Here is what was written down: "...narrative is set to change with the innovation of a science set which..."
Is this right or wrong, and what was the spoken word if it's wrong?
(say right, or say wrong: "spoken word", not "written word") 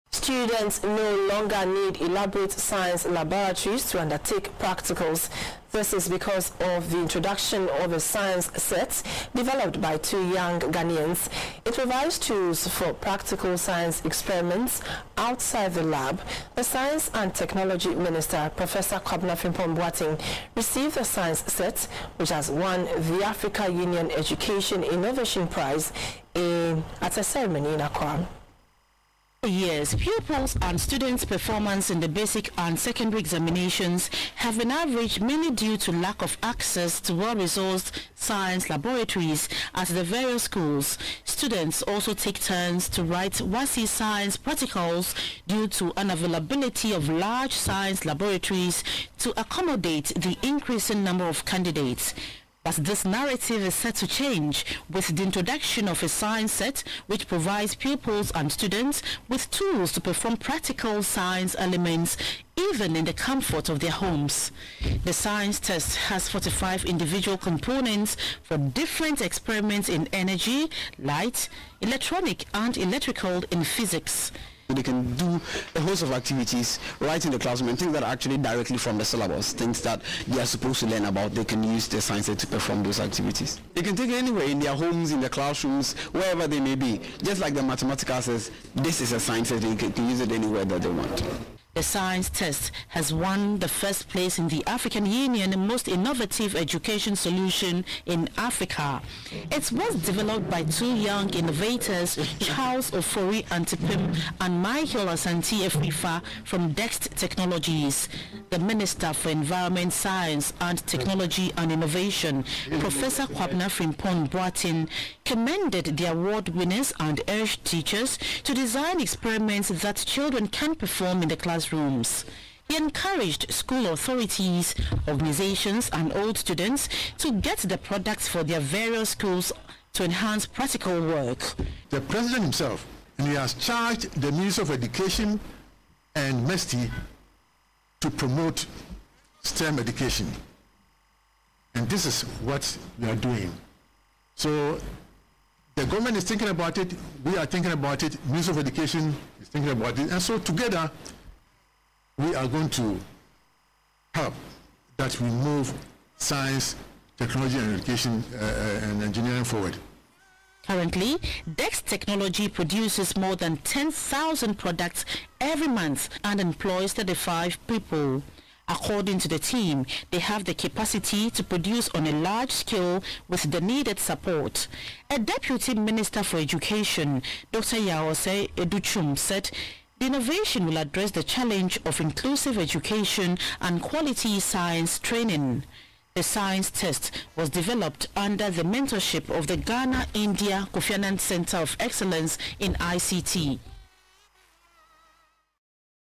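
wrong: "introduction", not "innovation".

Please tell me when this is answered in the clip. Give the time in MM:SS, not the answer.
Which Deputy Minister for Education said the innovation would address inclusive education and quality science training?
02:57.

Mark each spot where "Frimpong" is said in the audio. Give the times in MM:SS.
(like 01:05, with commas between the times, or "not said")
00:19, 01:53.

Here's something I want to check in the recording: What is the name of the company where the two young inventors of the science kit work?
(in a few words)
Dext Technologies.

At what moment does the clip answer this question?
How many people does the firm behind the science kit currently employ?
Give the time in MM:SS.
02:46.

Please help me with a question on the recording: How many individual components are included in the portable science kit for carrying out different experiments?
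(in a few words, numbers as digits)
45.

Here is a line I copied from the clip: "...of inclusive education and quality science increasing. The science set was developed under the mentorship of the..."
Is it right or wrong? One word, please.
wrong.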